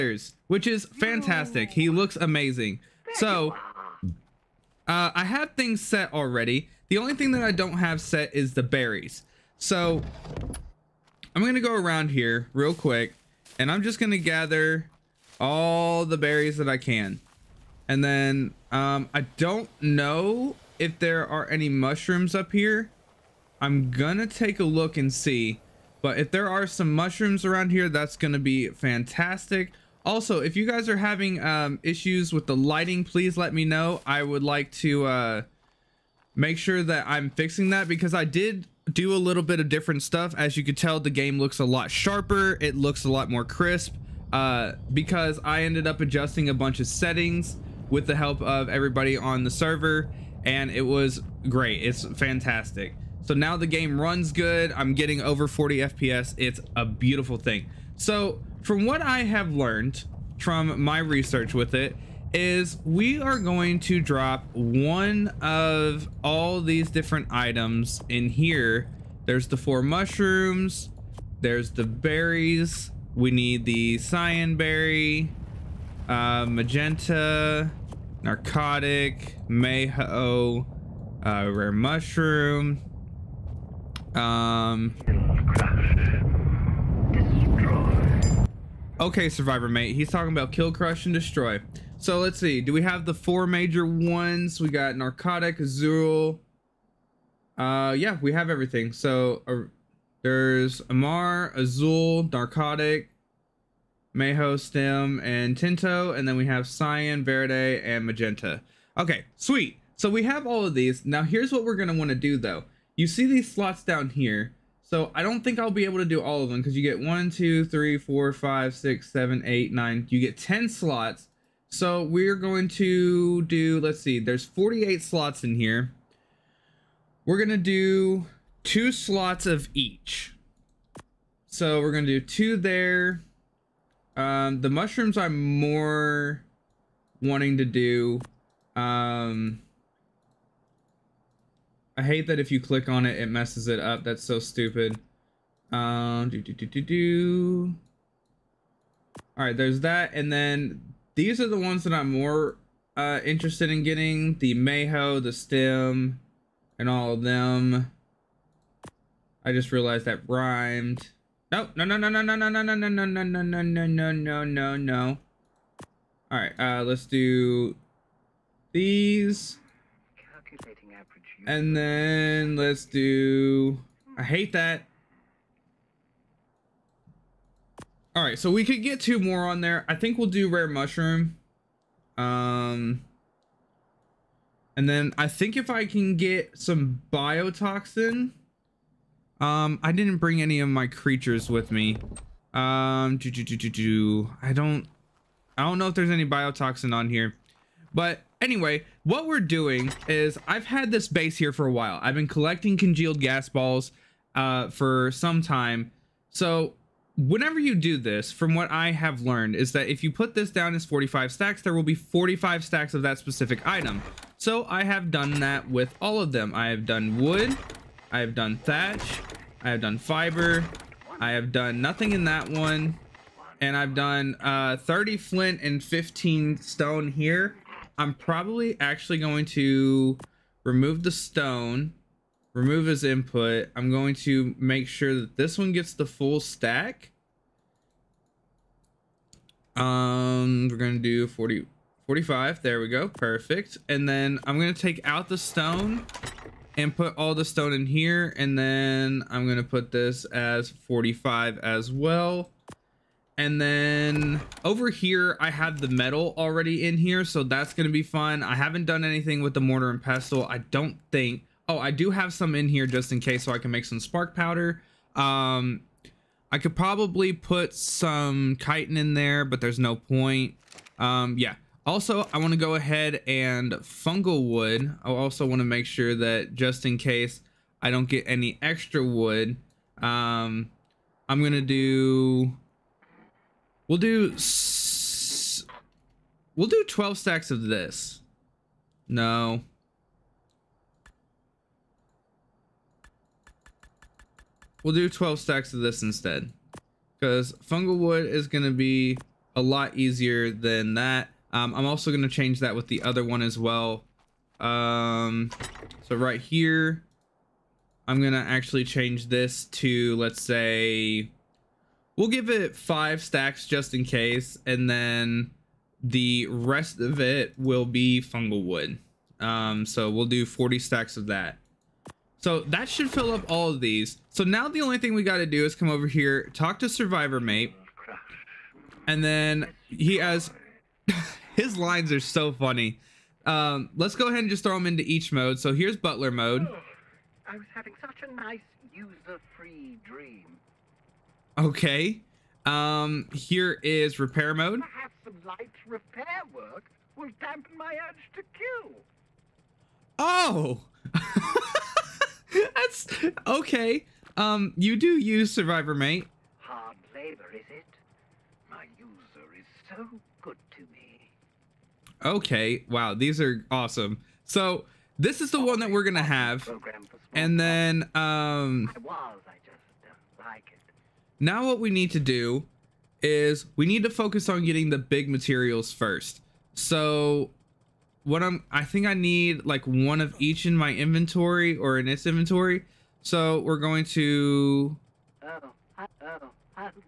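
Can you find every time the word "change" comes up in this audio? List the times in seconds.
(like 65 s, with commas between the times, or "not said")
302 s, 308 s.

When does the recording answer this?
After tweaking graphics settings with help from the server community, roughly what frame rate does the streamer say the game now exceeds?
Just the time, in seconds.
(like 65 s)
55 s.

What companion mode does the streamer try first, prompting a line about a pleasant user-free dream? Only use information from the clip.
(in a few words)
Butler mode.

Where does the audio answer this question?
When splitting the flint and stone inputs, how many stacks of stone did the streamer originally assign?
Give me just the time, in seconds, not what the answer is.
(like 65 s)
225 s.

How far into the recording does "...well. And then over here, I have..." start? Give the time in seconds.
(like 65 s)
251 s.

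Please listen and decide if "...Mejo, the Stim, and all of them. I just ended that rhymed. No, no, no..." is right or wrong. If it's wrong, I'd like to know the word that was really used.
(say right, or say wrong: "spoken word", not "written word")
wrong: "realized", not "ended".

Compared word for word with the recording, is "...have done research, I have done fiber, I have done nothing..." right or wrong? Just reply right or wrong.
wrong.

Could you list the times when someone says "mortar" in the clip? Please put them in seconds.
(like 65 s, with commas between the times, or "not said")
259 s.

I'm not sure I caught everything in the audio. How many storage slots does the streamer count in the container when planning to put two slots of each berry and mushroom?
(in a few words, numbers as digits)
48.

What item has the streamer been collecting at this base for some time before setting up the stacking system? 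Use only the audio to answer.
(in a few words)
congealed gas balls.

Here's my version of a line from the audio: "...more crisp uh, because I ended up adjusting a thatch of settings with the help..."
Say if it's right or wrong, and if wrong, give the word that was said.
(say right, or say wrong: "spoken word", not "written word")
wrong: "bunch", not "thatch".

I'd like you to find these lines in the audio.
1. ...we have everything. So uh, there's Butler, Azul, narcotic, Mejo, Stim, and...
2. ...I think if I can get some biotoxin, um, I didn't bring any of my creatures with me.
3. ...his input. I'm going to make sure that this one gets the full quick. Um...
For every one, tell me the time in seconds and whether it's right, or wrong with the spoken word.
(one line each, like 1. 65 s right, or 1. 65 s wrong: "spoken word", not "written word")
1. 98 s wrong: "Amar", not "Butler"
2. 185 s right
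3. 232 s wrong: "stack", not "quick".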